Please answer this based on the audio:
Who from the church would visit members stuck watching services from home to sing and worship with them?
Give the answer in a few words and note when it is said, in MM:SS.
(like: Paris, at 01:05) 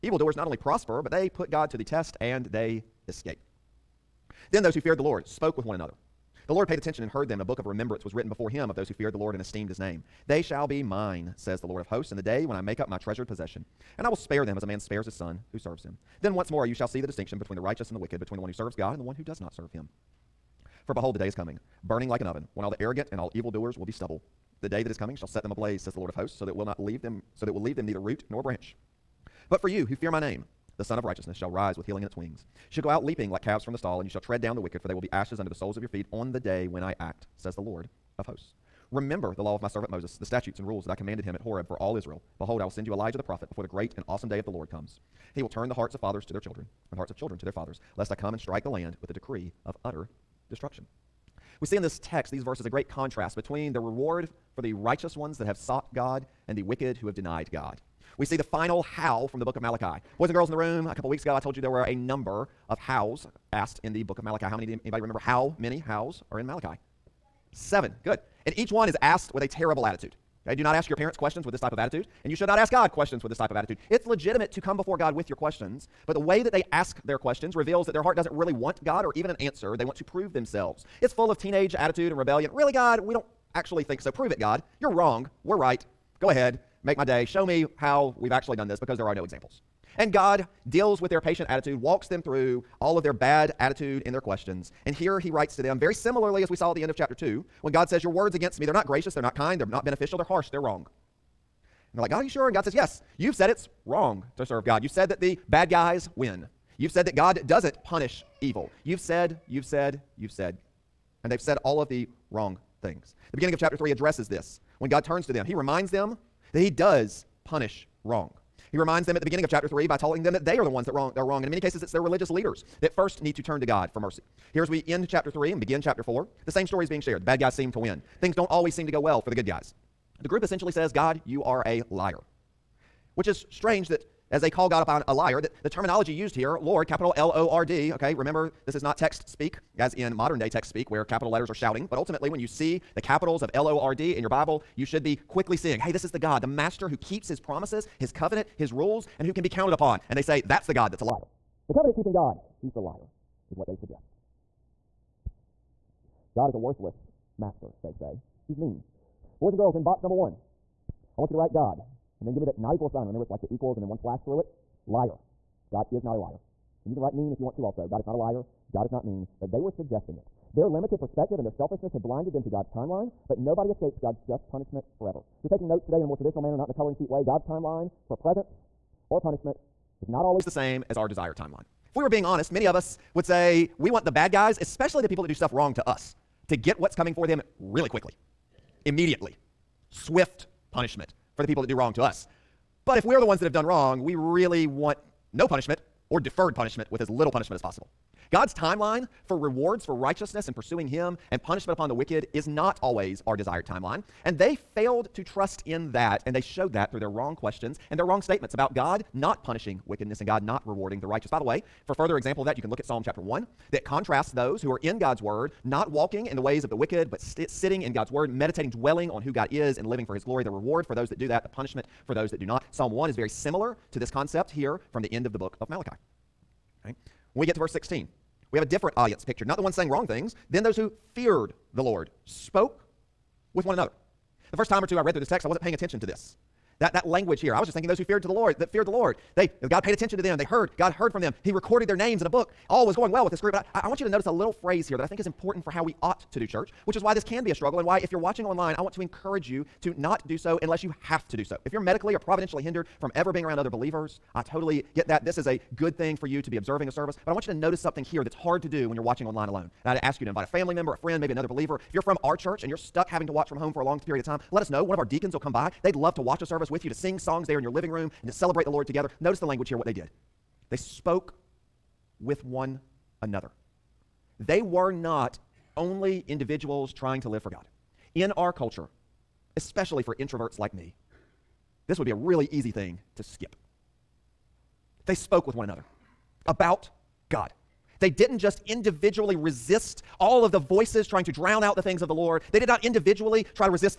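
deacons, at 04:25.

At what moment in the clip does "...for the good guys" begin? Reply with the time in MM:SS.
02:09.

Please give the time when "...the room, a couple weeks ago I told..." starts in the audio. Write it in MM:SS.
01:00.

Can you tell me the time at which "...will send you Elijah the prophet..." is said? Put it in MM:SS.
00:42.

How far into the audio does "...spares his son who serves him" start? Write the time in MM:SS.
00:14.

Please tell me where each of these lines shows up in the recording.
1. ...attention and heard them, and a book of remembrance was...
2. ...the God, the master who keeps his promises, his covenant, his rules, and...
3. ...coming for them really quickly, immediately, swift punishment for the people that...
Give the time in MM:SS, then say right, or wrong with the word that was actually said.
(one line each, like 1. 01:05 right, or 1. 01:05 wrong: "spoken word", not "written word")
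1. 00:06 right
2. 02:26 right
3. 03:06 right.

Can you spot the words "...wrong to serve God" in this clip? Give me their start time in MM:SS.
01:43.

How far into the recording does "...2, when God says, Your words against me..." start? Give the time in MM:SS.
01:37.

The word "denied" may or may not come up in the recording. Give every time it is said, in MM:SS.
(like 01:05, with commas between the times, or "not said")
00:57.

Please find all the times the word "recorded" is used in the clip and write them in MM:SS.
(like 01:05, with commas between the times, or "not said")
04:01.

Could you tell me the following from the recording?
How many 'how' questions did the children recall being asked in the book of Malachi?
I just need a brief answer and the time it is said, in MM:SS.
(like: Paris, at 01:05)
7, at 01:07.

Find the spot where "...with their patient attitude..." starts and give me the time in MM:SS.
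01:31.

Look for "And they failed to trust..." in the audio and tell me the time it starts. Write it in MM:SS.
03:24.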